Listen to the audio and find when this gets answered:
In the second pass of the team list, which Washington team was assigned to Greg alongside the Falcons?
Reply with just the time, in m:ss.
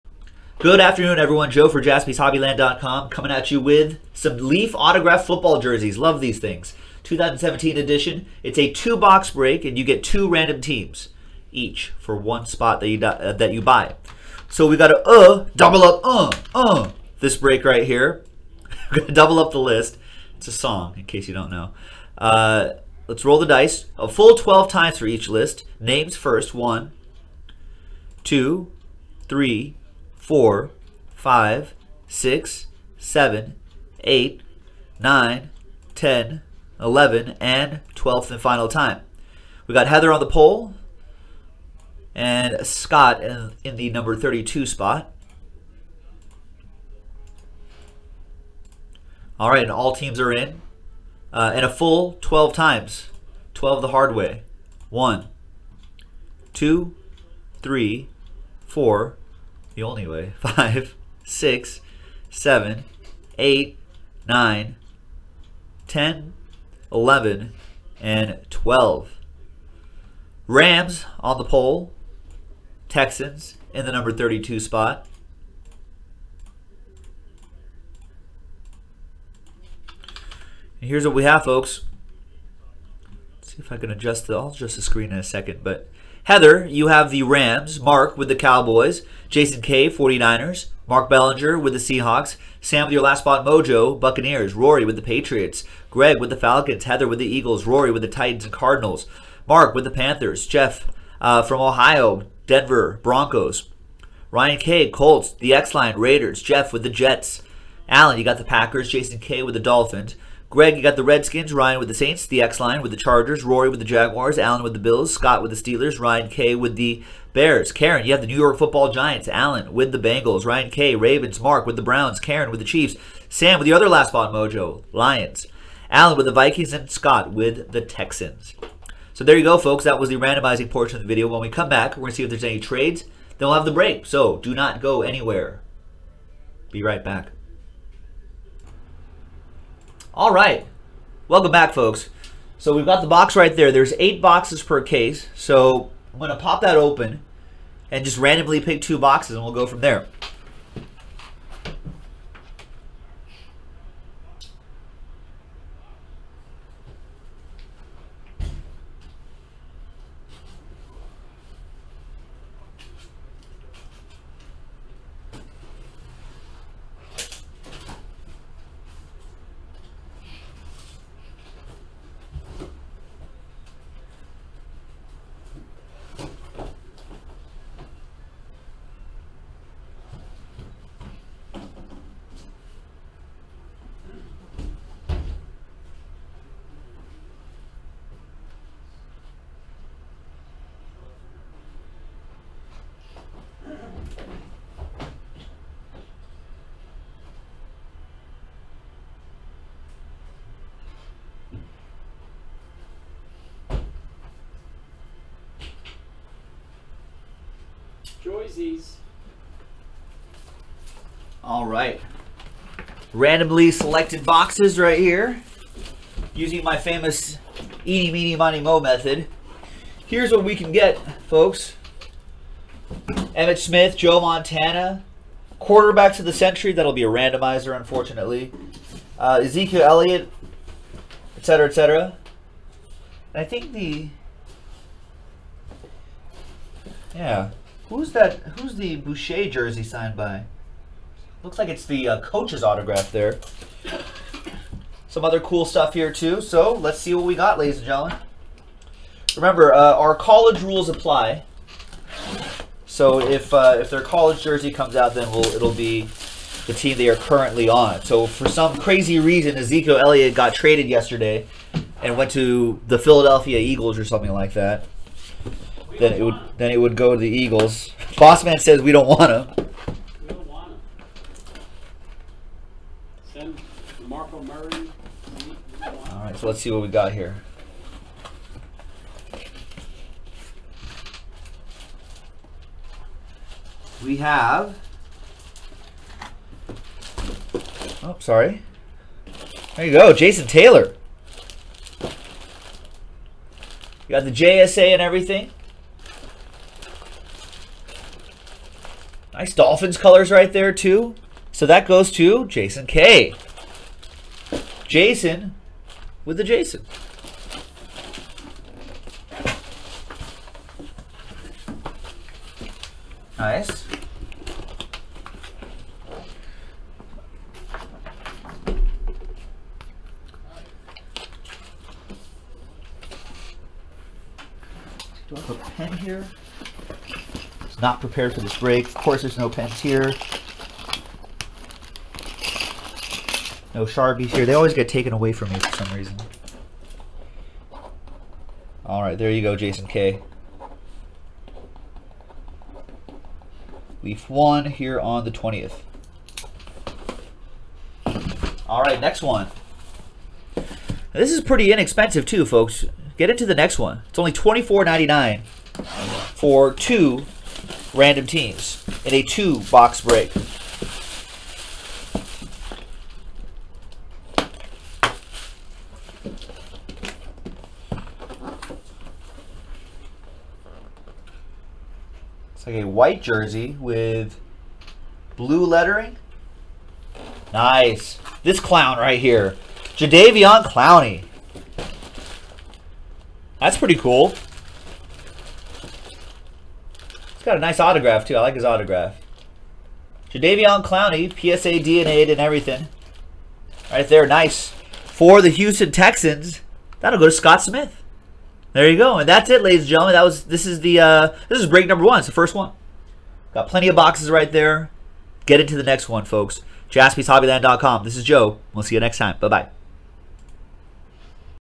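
1:51.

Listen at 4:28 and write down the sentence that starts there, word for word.
Bossman says we don't want him.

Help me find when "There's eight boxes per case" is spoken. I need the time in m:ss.
2:23.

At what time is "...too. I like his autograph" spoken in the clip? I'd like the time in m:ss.
6:28.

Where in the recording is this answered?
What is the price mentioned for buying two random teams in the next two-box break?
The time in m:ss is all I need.
5:54.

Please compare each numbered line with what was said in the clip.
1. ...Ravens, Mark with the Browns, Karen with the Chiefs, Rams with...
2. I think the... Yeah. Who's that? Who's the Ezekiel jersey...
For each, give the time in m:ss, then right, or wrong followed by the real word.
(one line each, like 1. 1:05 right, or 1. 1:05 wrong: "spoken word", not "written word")
1. 2:00 wrong: "Sam", not "Rams"
2. 3:53 wrong: "Boucher", not "Ezekiel".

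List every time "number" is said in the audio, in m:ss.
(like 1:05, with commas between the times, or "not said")
0:43, 1:13, 6:41.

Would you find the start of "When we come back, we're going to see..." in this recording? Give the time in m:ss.
2:11.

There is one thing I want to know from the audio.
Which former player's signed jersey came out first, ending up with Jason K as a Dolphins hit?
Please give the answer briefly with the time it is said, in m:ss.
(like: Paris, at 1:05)
Jason Taylor, at 4:50.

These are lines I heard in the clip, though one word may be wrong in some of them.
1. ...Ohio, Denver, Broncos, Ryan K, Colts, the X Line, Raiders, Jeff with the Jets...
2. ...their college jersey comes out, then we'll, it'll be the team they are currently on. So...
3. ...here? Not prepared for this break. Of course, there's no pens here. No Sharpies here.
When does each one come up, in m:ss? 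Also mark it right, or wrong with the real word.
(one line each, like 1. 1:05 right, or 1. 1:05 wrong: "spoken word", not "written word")
1. 1:41 right
2. 4:13 right
3. 5:25 right.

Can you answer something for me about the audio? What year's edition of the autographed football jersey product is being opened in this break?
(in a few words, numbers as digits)
2017.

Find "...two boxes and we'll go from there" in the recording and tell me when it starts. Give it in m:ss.
2:28.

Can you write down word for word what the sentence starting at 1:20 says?
And here's what we have, folks.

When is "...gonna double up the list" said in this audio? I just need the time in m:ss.
0:19.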